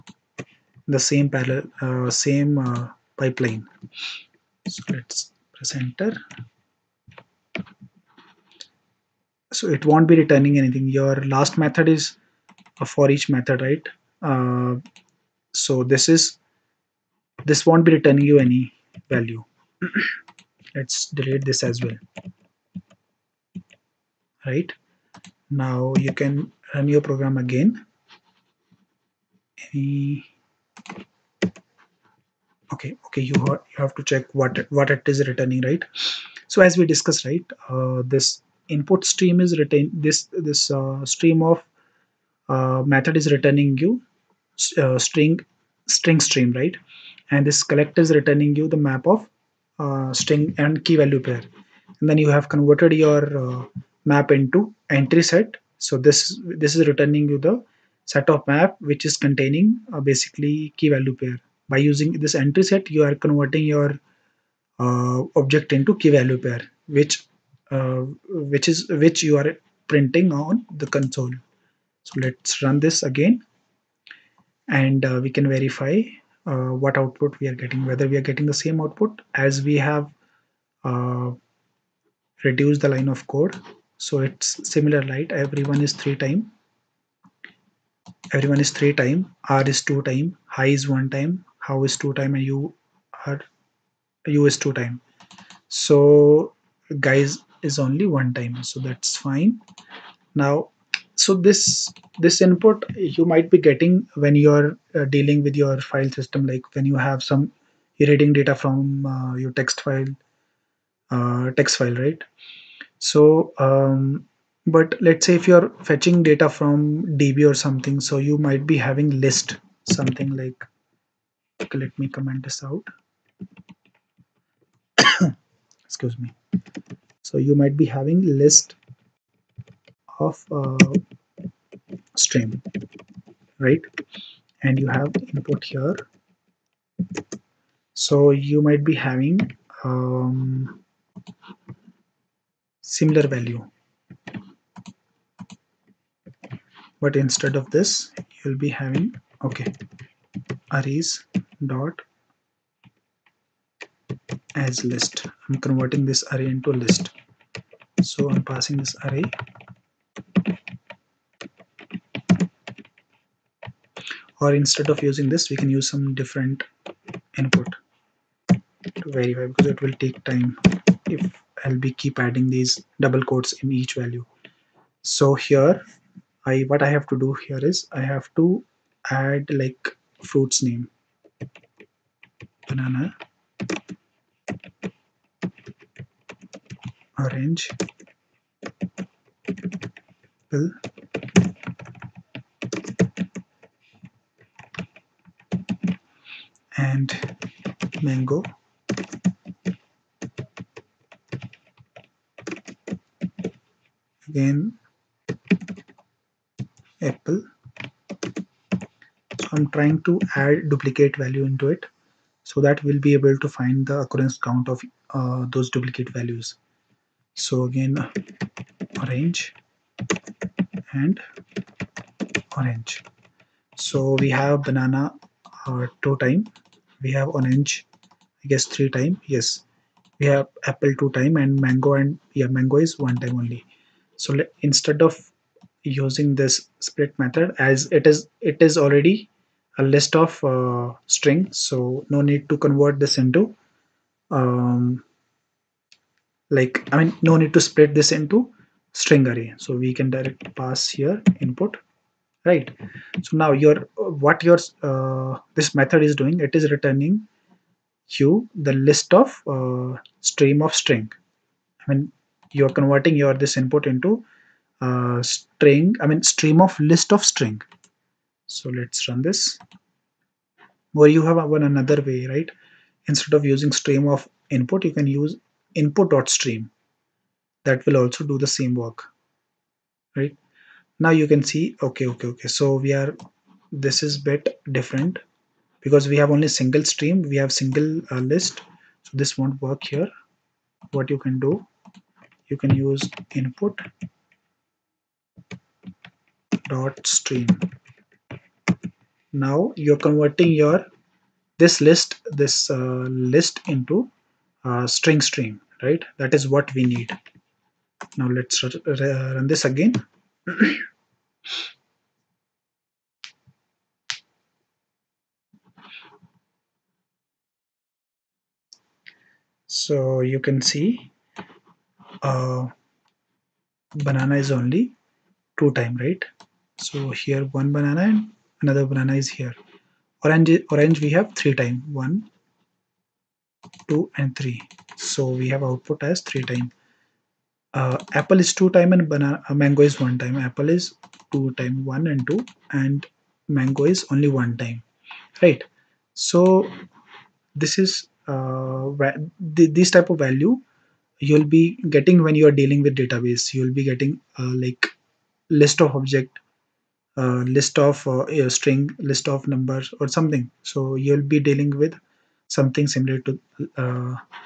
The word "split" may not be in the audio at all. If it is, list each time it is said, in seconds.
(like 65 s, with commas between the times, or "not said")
236 s, 247 s.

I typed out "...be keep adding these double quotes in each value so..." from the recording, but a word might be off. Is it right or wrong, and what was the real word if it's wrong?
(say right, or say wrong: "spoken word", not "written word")
right.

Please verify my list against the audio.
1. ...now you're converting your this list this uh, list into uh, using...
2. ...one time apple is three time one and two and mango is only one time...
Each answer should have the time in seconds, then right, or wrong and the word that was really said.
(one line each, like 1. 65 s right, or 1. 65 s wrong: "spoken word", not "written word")
1. 299 s wrong: "string", not "using"
2. 339 s wrong: "two", not "three".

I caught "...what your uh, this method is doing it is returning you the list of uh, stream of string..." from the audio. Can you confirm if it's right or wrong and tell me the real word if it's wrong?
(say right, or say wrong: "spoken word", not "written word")
right.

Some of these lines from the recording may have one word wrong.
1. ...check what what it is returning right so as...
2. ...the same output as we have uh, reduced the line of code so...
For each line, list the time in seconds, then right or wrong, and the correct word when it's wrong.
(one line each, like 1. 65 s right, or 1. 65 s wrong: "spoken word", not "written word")
1. 34 s right
2. 78 s right.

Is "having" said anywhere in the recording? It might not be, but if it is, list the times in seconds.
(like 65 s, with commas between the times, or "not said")
118 s, 127 s, 138 s, 148 s.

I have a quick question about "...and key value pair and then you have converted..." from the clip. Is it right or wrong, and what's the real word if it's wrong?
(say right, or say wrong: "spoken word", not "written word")
right.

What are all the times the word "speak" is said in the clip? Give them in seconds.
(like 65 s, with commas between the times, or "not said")
not said.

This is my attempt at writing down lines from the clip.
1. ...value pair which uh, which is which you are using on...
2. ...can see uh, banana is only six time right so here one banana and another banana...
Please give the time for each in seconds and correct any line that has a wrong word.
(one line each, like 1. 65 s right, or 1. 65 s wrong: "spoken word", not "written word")
1. 66 s wrong: "printing", not "using"
2. 320 s wrong: "two", not "six".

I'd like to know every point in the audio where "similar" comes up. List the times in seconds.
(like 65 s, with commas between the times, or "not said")
84 s, 142 s, 362 s.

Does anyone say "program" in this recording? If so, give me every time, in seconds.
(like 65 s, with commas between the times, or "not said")
27 s.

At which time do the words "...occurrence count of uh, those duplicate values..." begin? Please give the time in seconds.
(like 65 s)
214 s.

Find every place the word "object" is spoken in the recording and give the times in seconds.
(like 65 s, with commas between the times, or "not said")
65 s, 355 s.